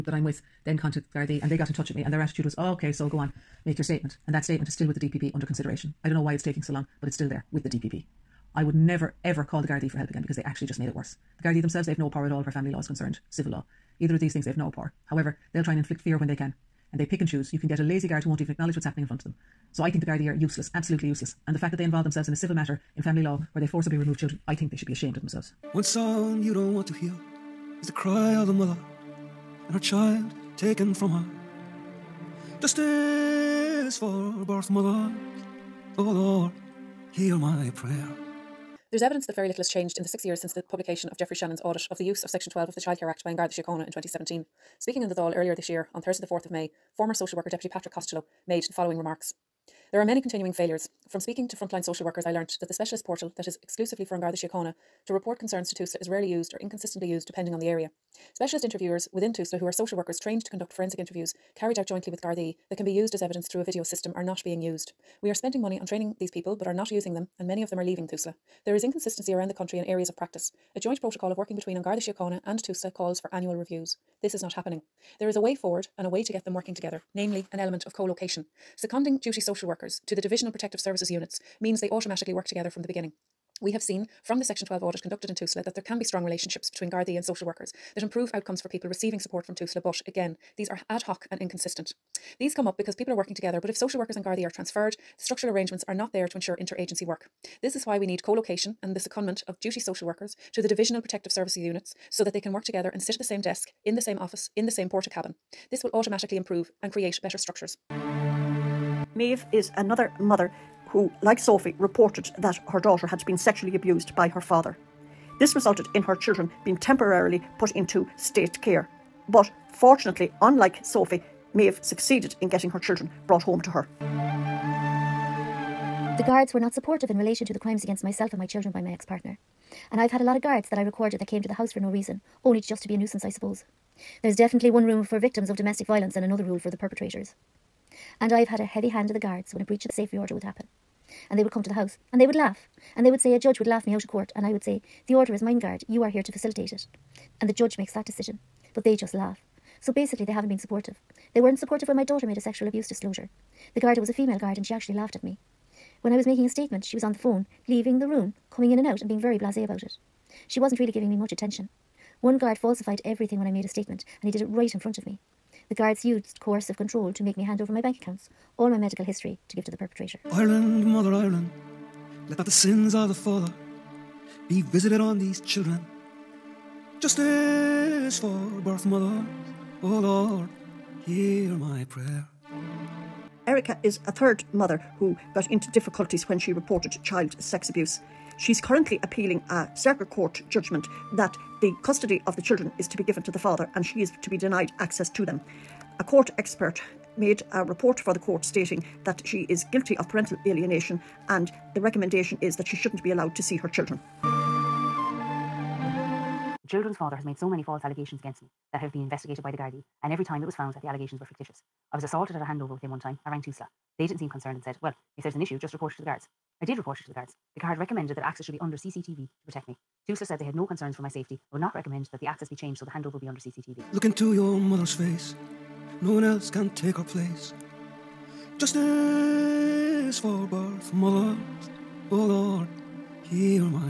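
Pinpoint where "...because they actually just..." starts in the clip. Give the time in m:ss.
0:10.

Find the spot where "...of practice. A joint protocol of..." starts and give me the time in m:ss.
1:10.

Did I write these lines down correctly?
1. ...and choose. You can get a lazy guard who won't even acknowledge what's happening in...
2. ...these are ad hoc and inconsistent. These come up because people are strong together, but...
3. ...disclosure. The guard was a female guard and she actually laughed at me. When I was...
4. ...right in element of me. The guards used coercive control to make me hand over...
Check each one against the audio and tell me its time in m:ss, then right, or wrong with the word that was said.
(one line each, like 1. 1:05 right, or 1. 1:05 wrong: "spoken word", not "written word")
1. 0:17 right
2. 1:30 wrong: "working", not "strong"
3. 2:32 right
4. 2:44 wrong: "front", not "element".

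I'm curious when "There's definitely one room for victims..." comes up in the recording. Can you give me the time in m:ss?
2:14.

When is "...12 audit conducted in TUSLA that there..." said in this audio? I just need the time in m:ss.
1:24.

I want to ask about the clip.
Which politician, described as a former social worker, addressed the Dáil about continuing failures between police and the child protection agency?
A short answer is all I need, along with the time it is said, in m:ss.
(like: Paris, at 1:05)
Patrick Costello, at 0:47.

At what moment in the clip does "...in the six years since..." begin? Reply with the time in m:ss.
0:39.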